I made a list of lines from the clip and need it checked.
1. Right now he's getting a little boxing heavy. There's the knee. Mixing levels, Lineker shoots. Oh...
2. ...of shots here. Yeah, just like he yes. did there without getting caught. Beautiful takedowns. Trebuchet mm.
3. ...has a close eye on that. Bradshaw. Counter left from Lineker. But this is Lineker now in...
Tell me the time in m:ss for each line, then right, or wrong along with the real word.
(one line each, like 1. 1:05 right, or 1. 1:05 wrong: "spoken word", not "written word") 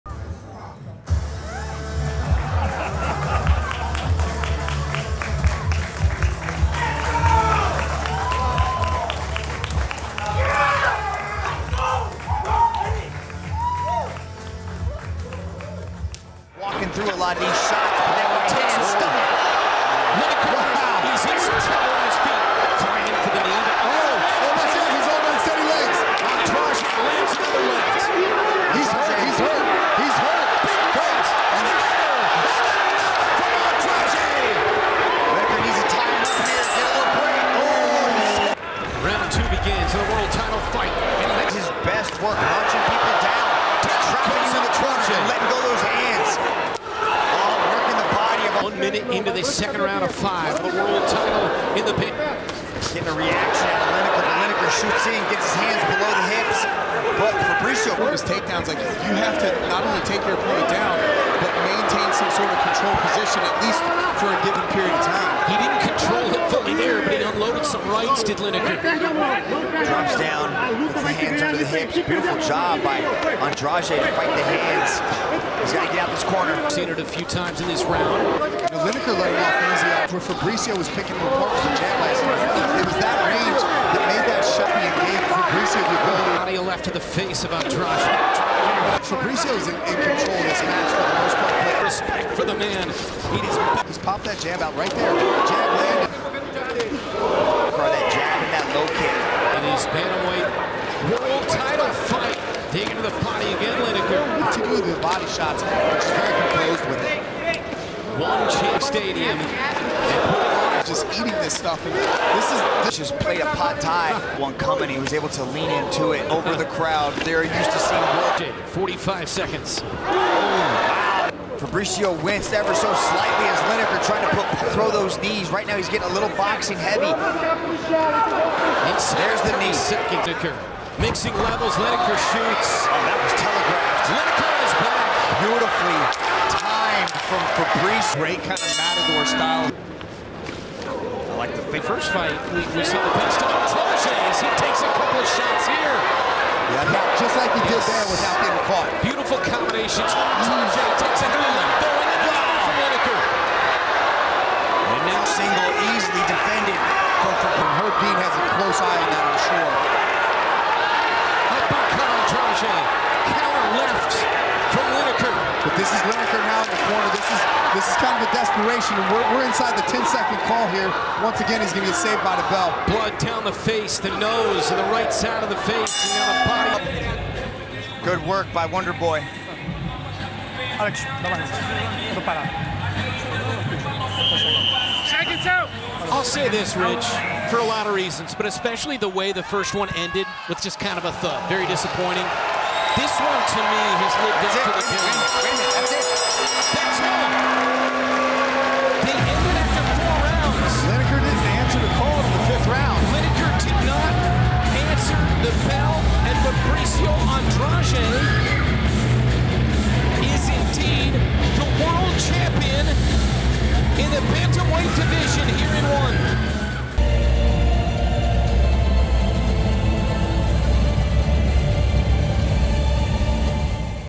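1. 2:05 right
2. 2:25 wrong: "combinations", not "takedowns"
3. 2:38 right.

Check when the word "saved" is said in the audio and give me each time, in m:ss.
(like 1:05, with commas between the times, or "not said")
2:51.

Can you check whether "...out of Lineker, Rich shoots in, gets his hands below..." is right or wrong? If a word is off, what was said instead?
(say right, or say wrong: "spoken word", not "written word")
wrong: "Lineker", not "Rich".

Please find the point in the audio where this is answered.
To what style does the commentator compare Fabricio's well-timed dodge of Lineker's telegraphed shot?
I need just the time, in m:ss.
2:18.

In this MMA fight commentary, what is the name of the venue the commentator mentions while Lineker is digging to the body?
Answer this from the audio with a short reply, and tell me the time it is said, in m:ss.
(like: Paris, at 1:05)
Chase Stadium, at 1:48.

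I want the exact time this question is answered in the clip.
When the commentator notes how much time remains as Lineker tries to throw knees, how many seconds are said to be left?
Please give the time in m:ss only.
1:58.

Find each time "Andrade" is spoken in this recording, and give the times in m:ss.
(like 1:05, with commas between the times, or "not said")
1:13, 1:27.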